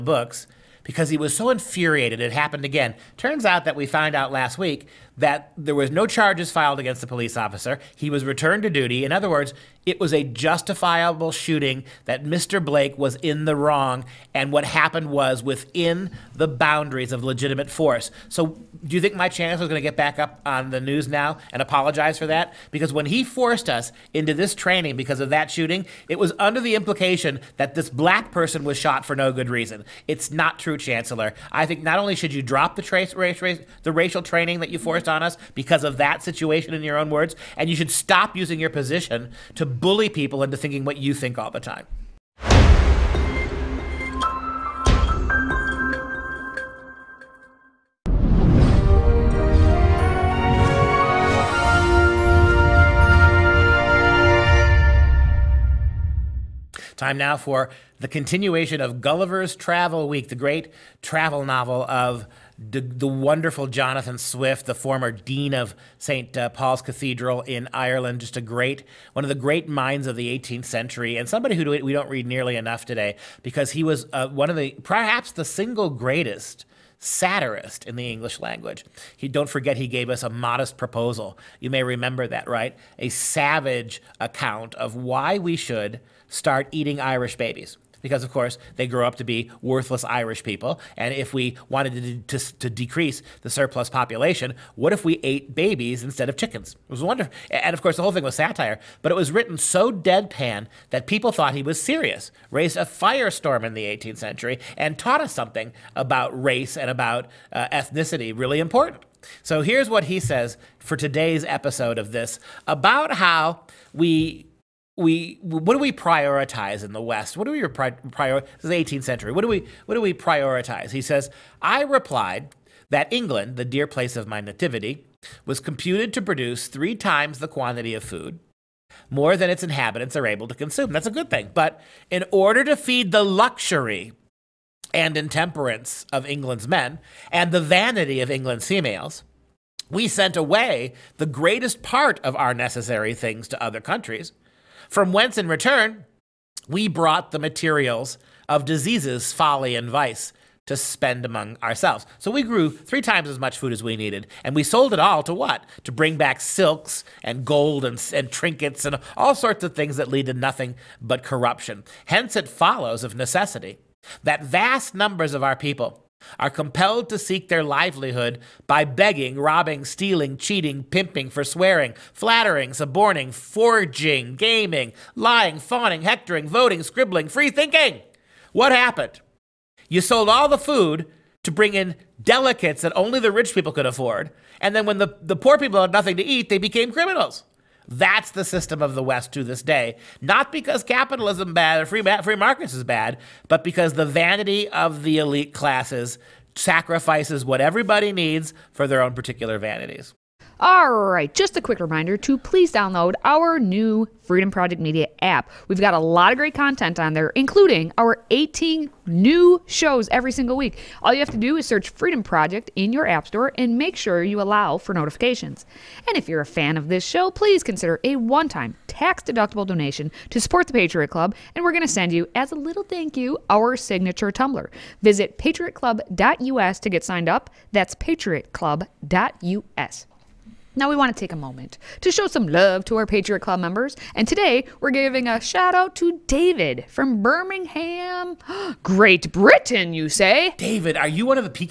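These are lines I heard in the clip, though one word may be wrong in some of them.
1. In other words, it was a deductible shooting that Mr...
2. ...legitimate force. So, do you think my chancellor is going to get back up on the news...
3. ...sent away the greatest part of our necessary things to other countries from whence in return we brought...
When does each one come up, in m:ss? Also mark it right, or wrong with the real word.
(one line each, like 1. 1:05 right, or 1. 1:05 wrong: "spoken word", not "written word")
1. 0:09 wrong: "justifiable", not "deductible"
2. 0:17 right
3. 2:20 right.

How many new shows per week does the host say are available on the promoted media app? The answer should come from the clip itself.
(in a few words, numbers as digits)
18.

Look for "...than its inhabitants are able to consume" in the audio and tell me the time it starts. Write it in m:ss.
2:09.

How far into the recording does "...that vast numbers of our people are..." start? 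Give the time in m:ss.
2:44.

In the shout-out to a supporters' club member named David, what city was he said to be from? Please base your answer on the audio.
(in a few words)
Birmingham.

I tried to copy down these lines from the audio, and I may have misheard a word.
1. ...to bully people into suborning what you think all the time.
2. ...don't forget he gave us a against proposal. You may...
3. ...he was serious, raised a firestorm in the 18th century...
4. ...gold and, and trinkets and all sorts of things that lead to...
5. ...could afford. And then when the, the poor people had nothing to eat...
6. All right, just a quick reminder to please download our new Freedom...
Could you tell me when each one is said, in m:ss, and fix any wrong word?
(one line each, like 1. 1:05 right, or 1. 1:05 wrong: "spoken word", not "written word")
1. 0:39 wrong: "thinking", not "suborning"
2. 1:19 wrong: "modest", not "against"
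3. 1:41 right
4. 2:37 right
5. 3:03 right
6. 3:20 right.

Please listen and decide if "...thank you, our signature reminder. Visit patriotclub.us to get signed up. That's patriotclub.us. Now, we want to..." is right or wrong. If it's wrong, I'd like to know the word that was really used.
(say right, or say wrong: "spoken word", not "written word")
wrong: "tumbler", not "reminder".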